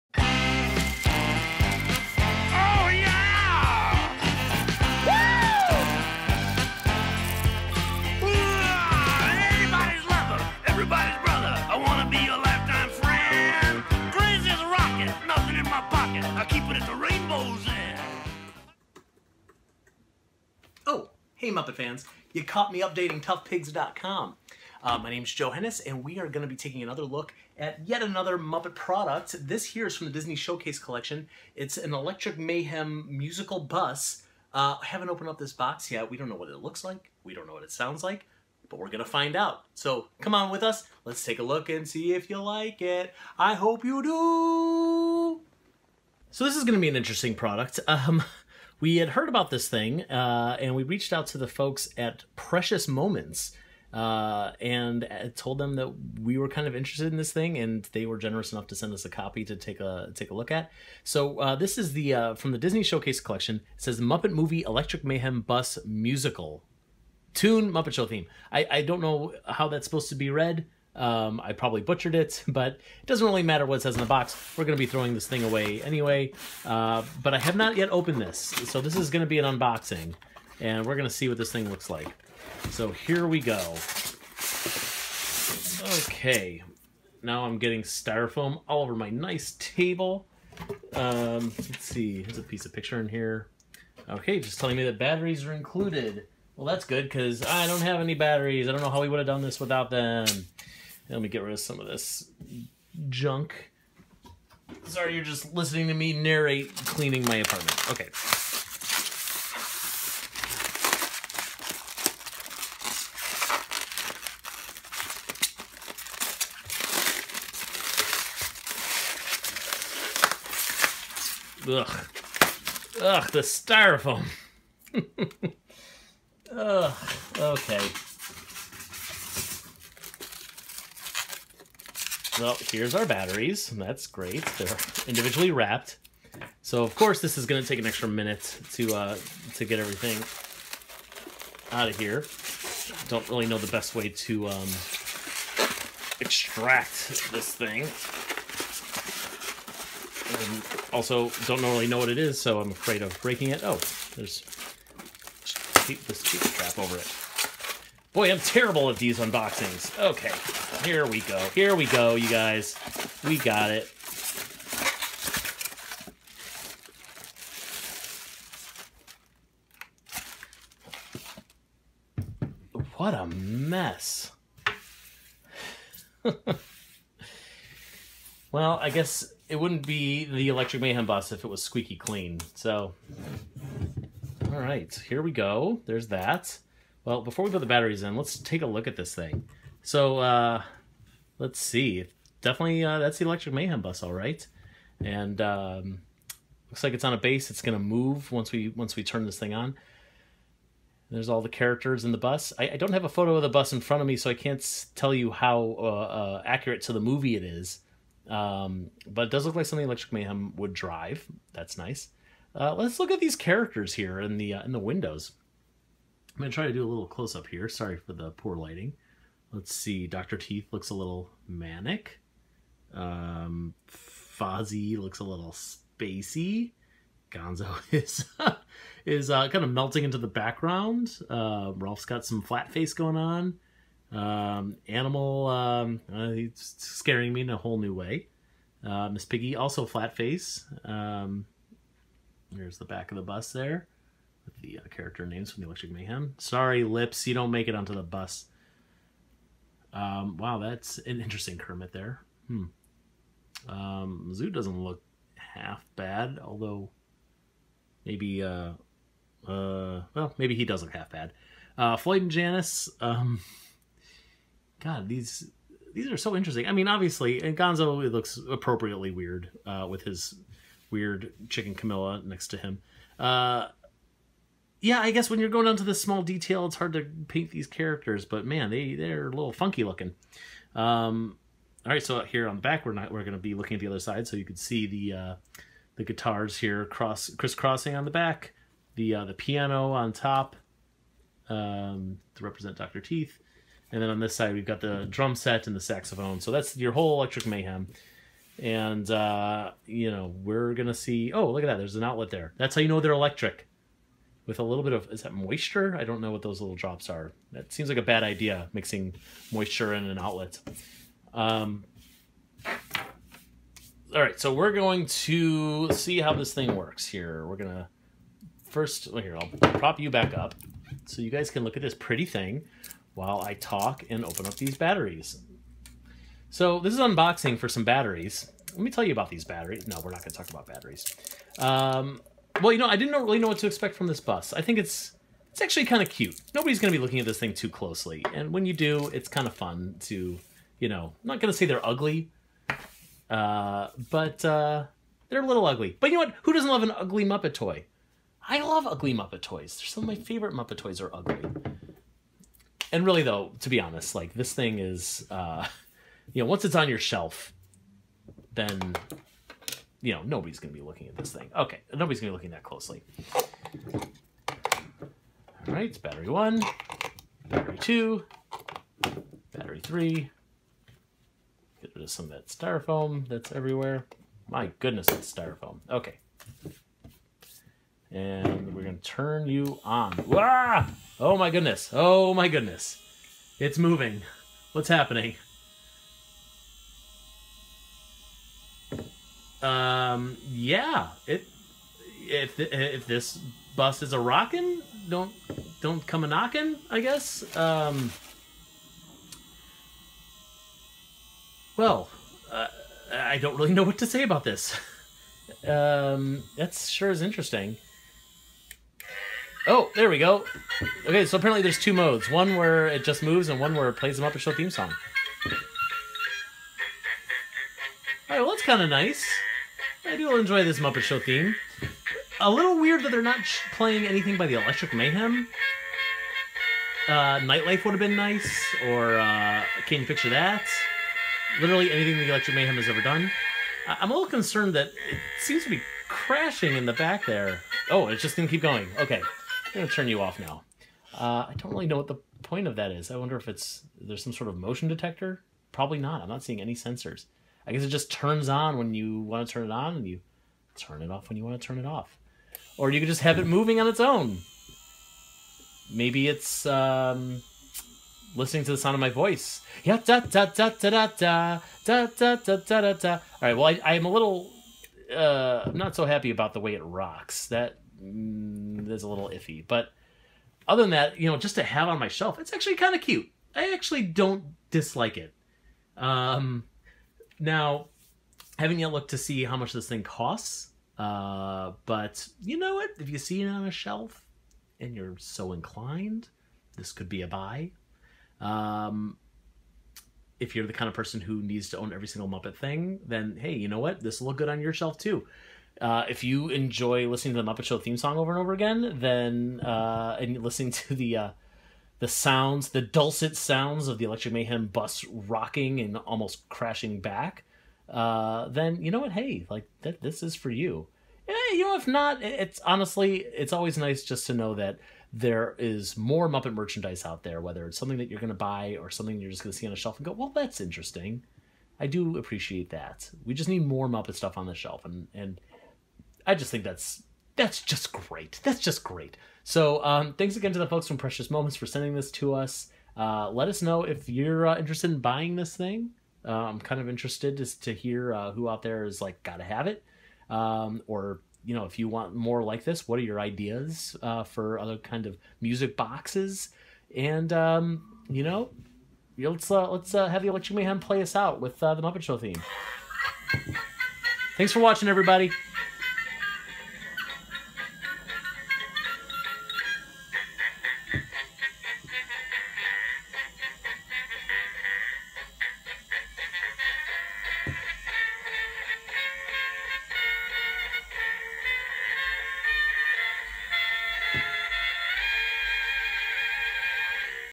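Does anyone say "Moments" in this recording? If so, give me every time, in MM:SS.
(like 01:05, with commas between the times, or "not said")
00:52, 08:51.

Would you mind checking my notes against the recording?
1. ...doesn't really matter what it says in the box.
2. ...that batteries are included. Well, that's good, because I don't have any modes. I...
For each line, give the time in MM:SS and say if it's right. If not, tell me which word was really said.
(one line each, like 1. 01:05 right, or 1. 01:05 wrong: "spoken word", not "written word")
1. 01:13 right
2. 01:34 wrong: "batteries", not "modes".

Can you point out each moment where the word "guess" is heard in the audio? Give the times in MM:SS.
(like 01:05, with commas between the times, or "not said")
02:58, 04:35, 06:37, 07:27.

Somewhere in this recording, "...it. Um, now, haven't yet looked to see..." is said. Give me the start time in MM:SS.
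07:55.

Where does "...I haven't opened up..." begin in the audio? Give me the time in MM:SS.
00:34.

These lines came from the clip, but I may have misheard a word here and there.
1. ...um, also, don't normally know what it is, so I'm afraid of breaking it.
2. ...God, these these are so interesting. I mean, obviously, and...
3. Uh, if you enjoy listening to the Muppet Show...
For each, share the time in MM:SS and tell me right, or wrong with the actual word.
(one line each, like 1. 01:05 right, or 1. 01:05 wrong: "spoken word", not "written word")
1. 02:30 right
2. 04:24 right
3. 08:15 right.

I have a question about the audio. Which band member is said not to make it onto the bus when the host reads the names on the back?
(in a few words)
Lips.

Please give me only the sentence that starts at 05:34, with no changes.
I think it's it's actually kind of cute.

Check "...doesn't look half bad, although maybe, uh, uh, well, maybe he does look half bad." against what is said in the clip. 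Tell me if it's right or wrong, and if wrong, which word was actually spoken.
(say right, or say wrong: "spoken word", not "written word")
right.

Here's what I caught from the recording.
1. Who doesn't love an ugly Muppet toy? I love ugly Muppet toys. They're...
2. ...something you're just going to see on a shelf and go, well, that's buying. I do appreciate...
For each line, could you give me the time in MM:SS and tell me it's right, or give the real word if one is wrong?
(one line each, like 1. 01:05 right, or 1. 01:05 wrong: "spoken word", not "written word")
1. 05:46 right
2. 08:38 wrong: "interesting", not "buying".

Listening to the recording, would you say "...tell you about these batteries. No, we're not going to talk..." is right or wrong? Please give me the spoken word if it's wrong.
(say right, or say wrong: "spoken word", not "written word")
right.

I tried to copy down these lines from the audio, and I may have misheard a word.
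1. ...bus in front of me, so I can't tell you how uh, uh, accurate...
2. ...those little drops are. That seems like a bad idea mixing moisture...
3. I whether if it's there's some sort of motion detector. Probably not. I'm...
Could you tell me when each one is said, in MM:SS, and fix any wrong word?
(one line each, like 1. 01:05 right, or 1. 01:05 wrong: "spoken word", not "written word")
1. 03:23 right
2. 05:06 right
3. 07:23 wrong: "wonder", not "whether".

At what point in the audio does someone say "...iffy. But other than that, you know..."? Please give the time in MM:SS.
07:49.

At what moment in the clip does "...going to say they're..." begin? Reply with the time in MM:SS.
05:41.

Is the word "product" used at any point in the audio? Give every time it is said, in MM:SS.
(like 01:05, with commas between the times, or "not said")
00:28, 00:47.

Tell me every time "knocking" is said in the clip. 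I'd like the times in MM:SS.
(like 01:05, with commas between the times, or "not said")
06:36.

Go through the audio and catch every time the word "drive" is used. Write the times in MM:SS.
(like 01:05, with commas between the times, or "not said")
03:30.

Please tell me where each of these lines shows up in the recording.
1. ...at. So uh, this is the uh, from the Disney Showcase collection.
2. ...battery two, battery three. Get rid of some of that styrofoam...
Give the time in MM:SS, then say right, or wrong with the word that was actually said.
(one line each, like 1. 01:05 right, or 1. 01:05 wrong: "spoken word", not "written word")
1. 01:00 right
2. 06:07 right.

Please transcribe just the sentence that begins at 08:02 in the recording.
If you see it on a shelf and you're so inclined, this could be a buy.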